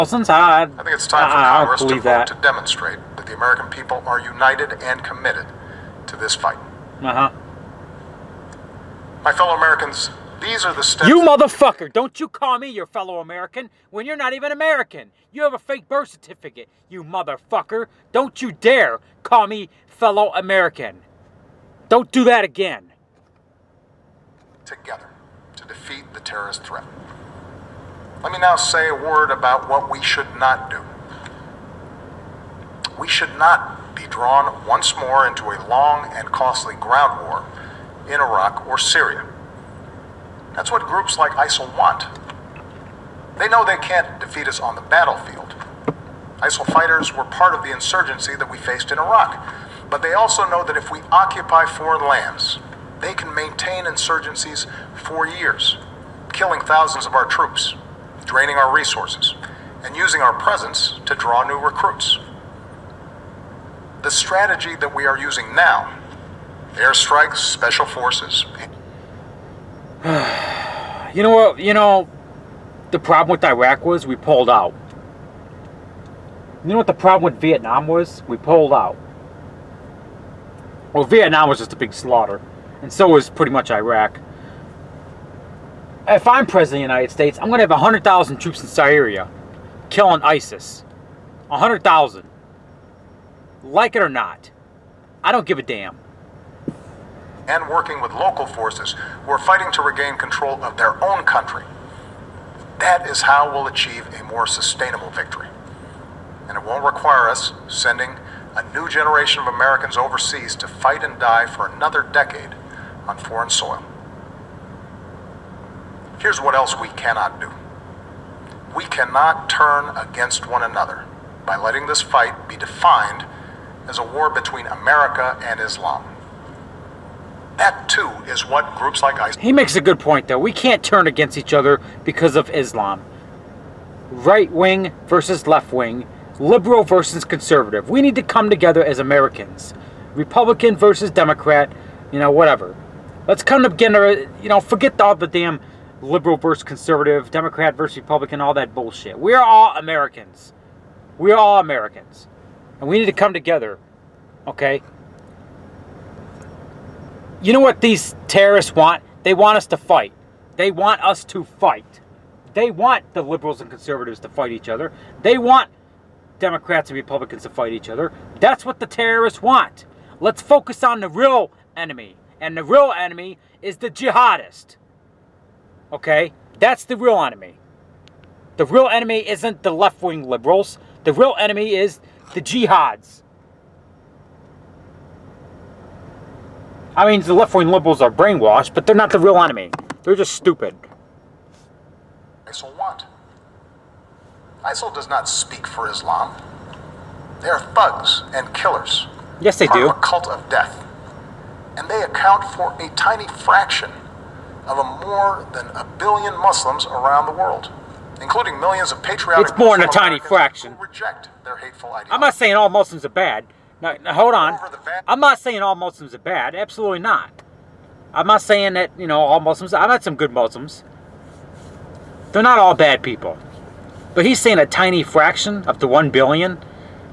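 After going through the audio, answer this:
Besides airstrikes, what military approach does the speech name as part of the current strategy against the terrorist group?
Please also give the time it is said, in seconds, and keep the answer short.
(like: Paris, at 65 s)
special forces, at 67 s.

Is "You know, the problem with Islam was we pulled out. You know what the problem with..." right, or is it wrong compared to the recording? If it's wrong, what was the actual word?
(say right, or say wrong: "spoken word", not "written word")
wrong: "Iraq", not "Islam".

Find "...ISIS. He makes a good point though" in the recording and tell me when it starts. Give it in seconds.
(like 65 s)
129 s.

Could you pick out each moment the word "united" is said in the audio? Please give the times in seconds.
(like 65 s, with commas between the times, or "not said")
4 s, 86 s.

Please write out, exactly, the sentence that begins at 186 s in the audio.
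I mean, the left-wing liberals are brainwashed, but they're not the real enemy.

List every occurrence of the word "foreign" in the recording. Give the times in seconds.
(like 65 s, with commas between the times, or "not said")
51 s, 113 s.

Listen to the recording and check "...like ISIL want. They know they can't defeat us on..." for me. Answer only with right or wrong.
right.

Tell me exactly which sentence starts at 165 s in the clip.
They want Democrats and Republicans to fight each other.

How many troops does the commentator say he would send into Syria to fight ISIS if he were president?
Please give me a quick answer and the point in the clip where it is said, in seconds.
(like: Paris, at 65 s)
100,000, at 87 s.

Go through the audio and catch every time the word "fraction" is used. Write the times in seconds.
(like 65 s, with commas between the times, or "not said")
203 s, 210 s, 225 s.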